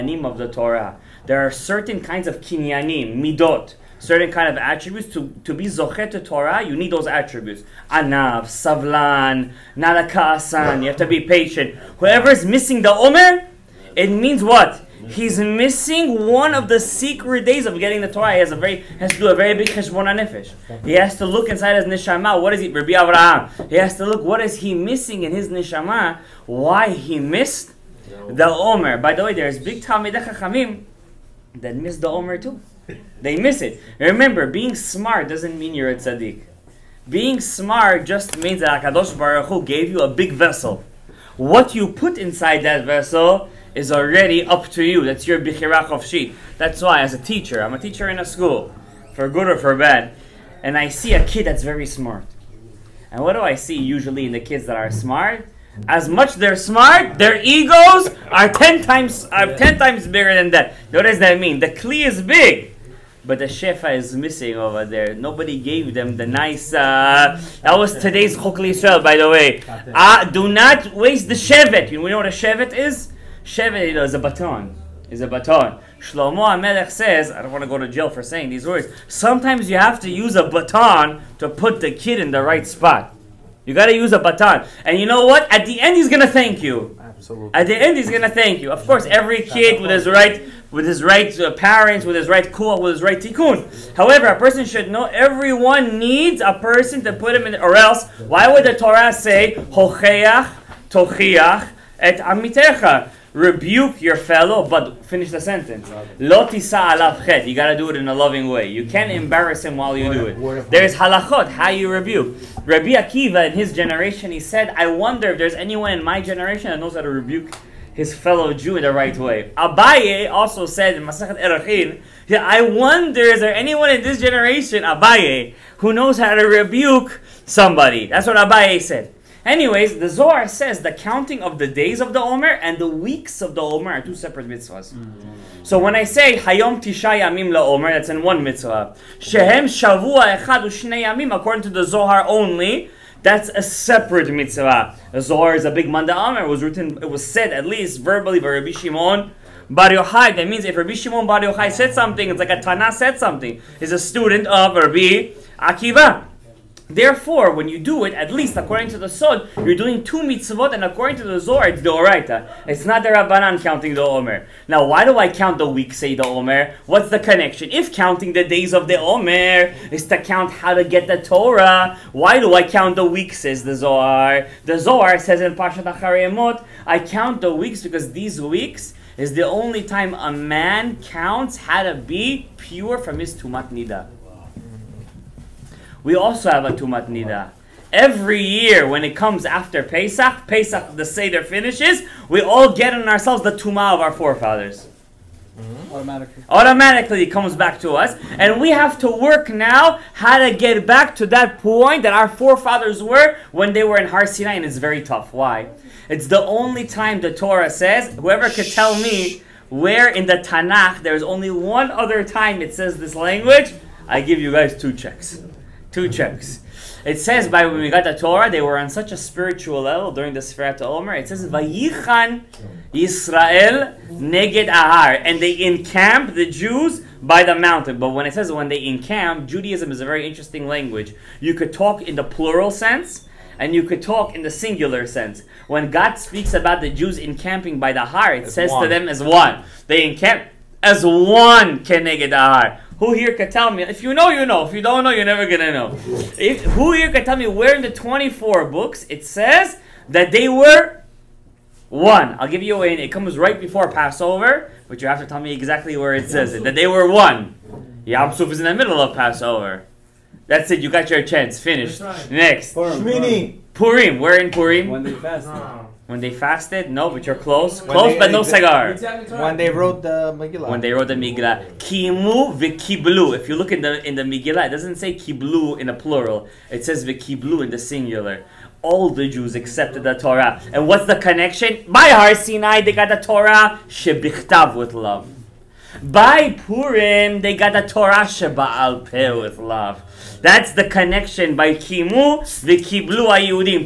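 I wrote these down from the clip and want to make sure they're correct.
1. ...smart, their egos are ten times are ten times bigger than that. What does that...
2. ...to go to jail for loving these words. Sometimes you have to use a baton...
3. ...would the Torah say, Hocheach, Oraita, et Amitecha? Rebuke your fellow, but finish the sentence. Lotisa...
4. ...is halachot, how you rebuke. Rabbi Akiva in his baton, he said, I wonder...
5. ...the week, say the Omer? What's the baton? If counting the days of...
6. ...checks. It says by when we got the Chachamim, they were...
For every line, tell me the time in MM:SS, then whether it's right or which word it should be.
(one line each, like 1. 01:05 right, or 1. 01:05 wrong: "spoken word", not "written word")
1. 00:56 right
2. 01:17 wrong: "saying", not "loving"
3. 01:38 wrong: "Tochiach", not "Oraita"
4. 01:50 wrong: "generation", not "baton"
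5. 02:45 wrong: "connection", not "baton"
6. 03:36 wrong: "Torah", not "Chachamim".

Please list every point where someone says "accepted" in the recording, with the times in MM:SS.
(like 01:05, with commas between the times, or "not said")
04:39.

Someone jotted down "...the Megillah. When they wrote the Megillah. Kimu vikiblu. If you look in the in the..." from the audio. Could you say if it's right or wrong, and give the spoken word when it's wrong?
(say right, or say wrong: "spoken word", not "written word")
right.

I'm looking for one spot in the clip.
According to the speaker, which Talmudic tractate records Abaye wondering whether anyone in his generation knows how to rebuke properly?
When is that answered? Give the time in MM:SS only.
02:01.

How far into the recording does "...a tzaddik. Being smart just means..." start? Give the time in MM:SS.
00:35.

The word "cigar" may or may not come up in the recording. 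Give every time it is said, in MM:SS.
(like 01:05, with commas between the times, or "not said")
04:28.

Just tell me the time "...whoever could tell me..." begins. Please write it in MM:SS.
03:28.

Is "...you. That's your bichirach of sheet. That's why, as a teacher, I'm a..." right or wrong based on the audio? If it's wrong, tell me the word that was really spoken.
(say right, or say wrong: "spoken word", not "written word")
right.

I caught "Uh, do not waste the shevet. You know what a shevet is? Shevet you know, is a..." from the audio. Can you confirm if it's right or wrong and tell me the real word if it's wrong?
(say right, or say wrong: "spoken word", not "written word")
right.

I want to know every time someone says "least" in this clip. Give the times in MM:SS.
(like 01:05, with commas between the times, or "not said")
02:27, 02:38.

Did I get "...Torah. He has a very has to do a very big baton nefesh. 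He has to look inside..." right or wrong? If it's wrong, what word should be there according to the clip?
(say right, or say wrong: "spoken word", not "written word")
wrong: "cheshbon", not "baton".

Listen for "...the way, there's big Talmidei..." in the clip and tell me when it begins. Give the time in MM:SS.
00:29.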